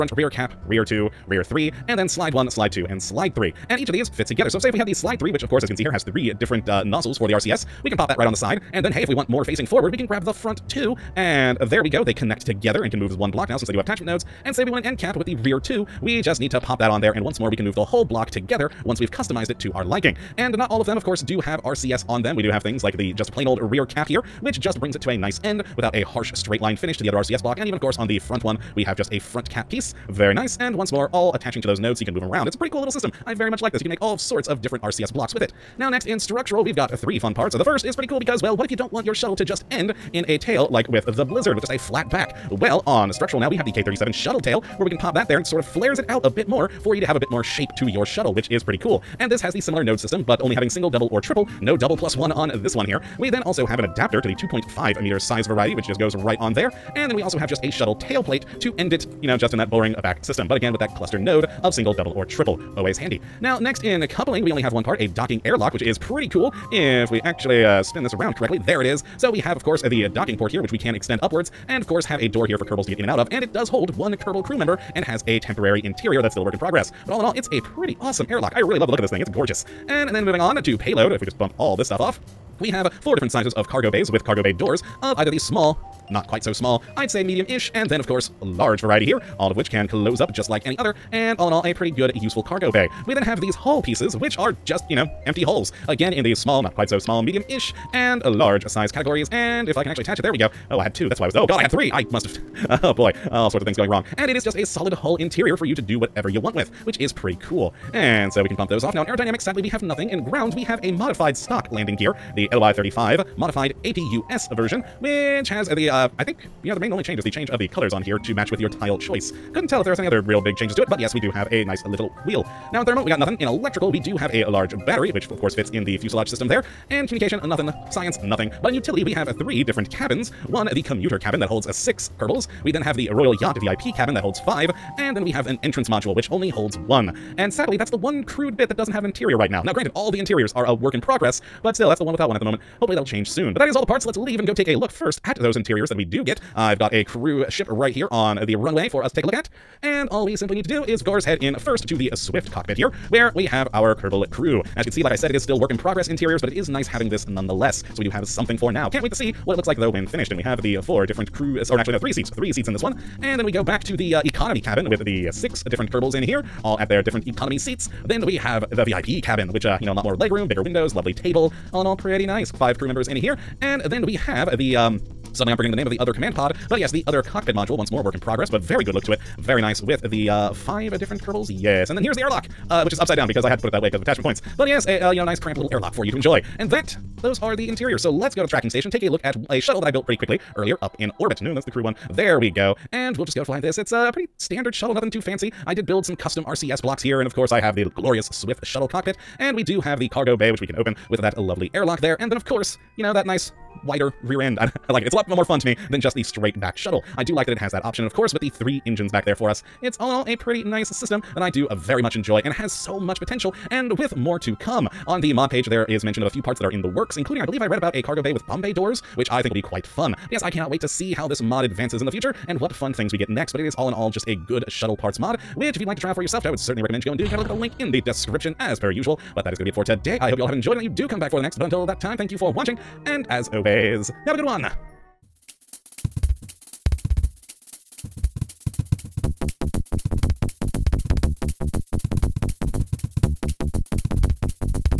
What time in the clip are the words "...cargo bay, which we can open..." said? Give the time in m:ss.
3:20.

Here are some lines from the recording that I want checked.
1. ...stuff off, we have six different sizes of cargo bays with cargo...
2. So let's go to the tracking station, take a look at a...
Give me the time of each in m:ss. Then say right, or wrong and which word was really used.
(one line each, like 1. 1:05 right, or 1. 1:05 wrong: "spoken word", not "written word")
1. 1:21 wrong: "four", not "six"
2. 3:08 right.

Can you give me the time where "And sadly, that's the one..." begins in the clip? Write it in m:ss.
2:17.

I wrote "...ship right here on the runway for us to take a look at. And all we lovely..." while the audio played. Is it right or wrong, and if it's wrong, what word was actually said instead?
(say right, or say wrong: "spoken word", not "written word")
wrong: "simply", not "lovely".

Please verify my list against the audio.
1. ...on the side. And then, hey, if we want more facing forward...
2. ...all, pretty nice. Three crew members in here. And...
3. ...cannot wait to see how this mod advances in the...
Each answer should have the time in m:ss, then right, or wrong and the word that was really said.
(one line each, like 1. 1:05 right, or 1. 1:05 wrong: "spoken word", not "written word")
1. 0:08 right
2. 2:51 wrong: "Five", not "Three"
3. 3:40 right.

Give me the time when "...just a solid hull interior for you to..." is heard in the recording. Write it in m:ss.
1:44.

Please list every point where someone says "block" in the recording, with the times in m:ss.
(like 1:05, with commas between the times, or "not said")
0:13, 0:18, 0:27, 0:35, 3:16.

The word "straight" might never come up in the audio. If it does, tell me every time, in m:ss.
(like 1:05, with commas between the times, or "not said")
0:26, 3:26.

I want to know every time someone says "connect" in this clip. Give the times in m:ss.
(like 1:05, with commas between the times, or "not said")
0:12.